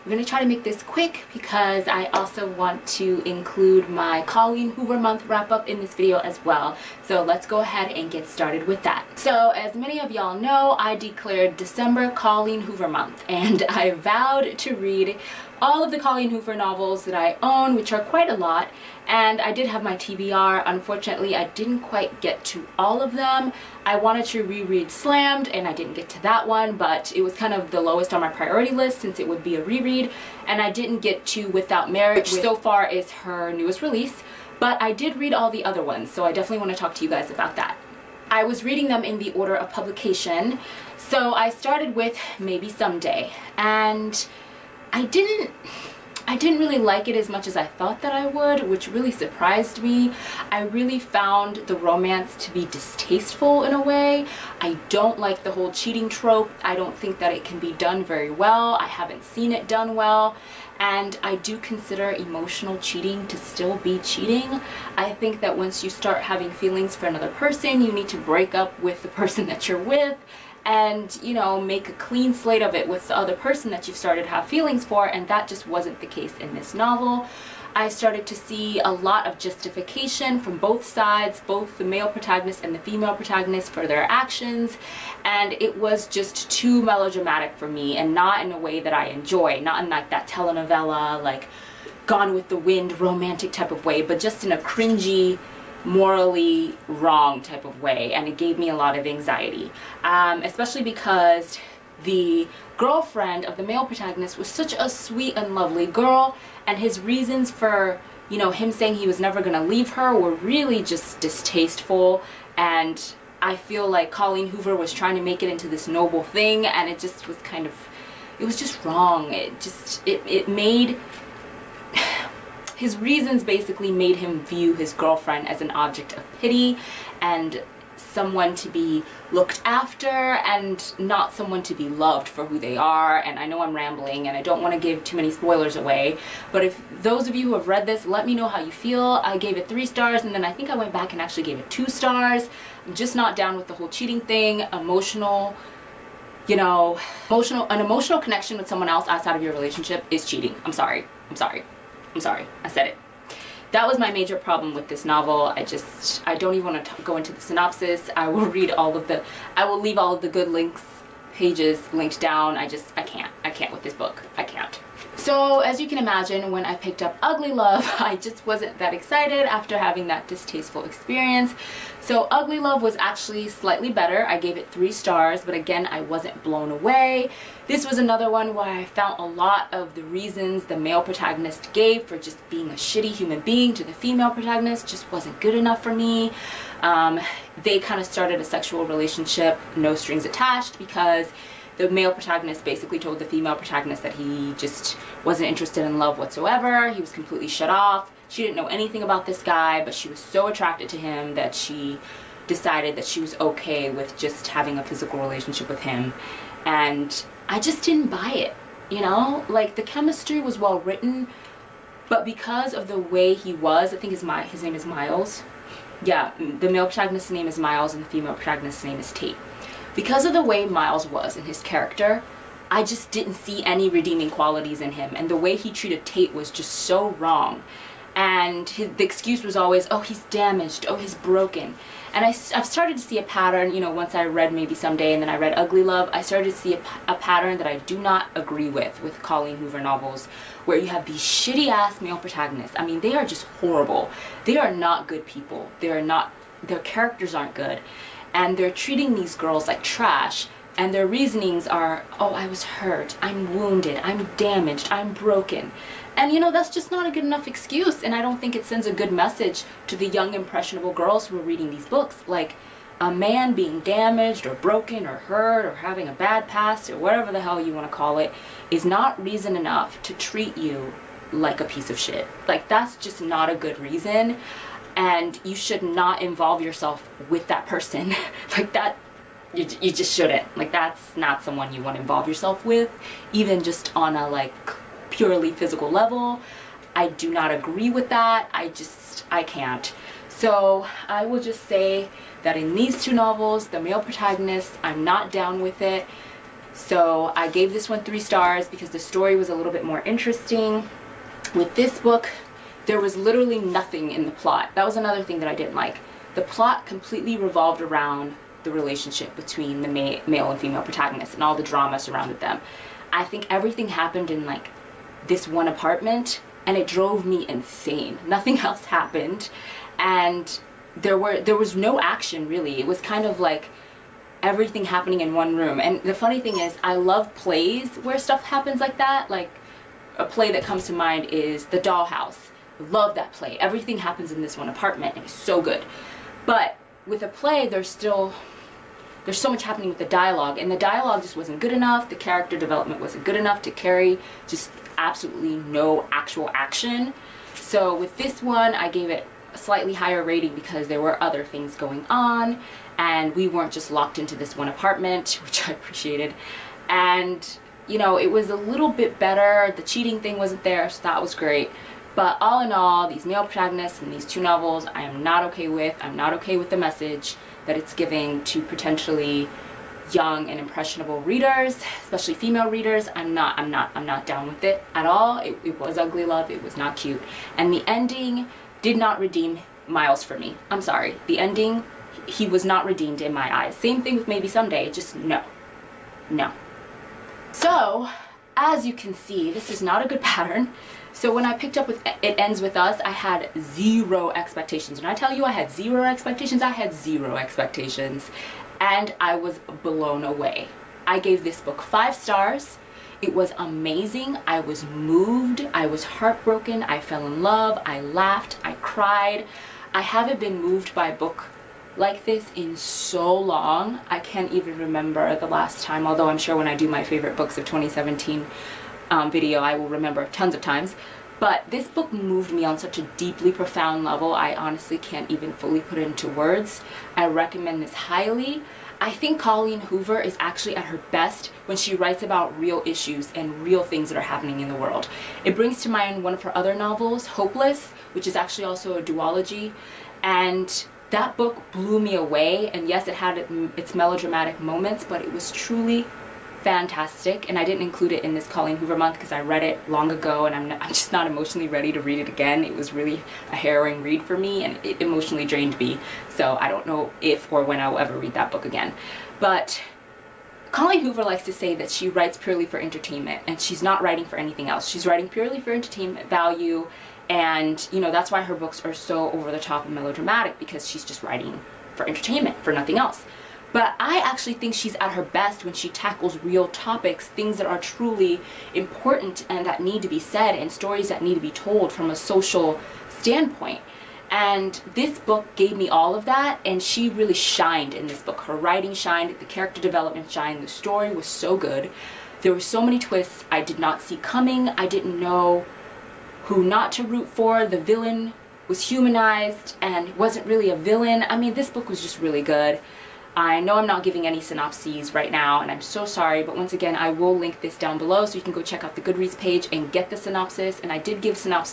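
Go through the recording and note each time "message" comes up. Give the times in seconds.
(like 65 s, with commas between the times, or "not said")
259 s, 366 s.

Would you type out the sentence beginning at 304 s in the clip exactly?
That was another thing that I didn't like.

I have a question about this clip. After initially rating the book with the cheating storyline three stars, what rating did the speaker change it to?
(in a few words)
2 stars.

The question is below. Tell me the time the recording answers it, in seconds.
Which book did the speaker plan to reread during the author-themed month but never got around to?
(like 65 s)
24 s.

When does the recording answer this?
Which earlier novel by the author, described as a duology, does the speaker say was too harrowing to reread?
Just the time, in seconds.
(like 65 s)
437 s.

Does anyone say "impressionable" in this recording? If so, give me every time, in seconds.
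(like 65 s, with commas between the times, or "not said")
260 s, 370 s.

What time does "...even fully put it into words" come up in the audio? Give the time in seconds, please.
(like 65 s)
425 s.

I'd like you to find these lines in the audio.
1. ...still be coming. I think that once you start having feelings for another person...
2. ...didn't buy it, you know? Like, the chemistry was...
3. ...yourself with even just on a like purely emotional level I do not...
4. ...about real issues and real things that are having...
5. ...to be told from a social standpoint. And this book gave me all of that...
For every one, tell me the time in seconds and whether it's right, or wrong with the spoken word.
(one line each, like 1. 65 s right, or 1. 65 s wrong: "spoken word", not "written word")
1. 63 s wrong: "cheating", not "coming"
2. 207 s right
3. 282 s wrong: "physical", not "emotional"
4. 432 s wrong: "happening", not "having"
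5. 481 s right.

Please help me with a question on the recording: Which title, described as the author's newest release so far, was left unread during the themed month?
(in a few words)
Without Merit.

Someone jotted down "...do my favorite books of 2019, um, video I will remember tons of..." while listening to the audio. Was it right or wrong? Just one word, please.
wrong.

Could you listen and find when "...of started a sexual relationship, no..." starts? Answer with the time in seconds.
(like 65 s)
187 s.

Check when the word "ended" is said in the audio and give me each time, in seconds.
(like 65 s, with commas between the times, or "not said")
not said.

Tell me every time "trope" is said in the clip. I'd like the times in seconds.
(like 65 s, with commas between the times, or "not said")
56 s.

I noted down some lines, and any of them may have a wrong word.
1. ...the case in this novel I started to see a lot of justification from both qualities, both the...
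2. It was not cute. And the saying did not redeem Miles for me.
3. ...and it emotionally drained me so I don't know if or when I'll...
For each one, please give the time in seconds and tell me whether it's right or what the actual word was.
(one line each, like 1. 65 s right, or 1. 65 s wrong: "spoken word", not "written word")
1. 76 s wrong: "sides", not "qualities"
2. 376 s wrong: "ending", not "saying"
3. 454 s right.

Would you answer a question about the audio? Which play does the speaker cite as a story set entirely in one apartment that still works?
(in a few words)
The Dollhouse.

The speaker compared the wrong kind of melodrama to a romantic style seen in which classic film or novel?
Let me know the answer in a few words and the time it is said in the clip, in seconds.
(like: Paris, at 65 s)
Gone with the Wind, at 92 s.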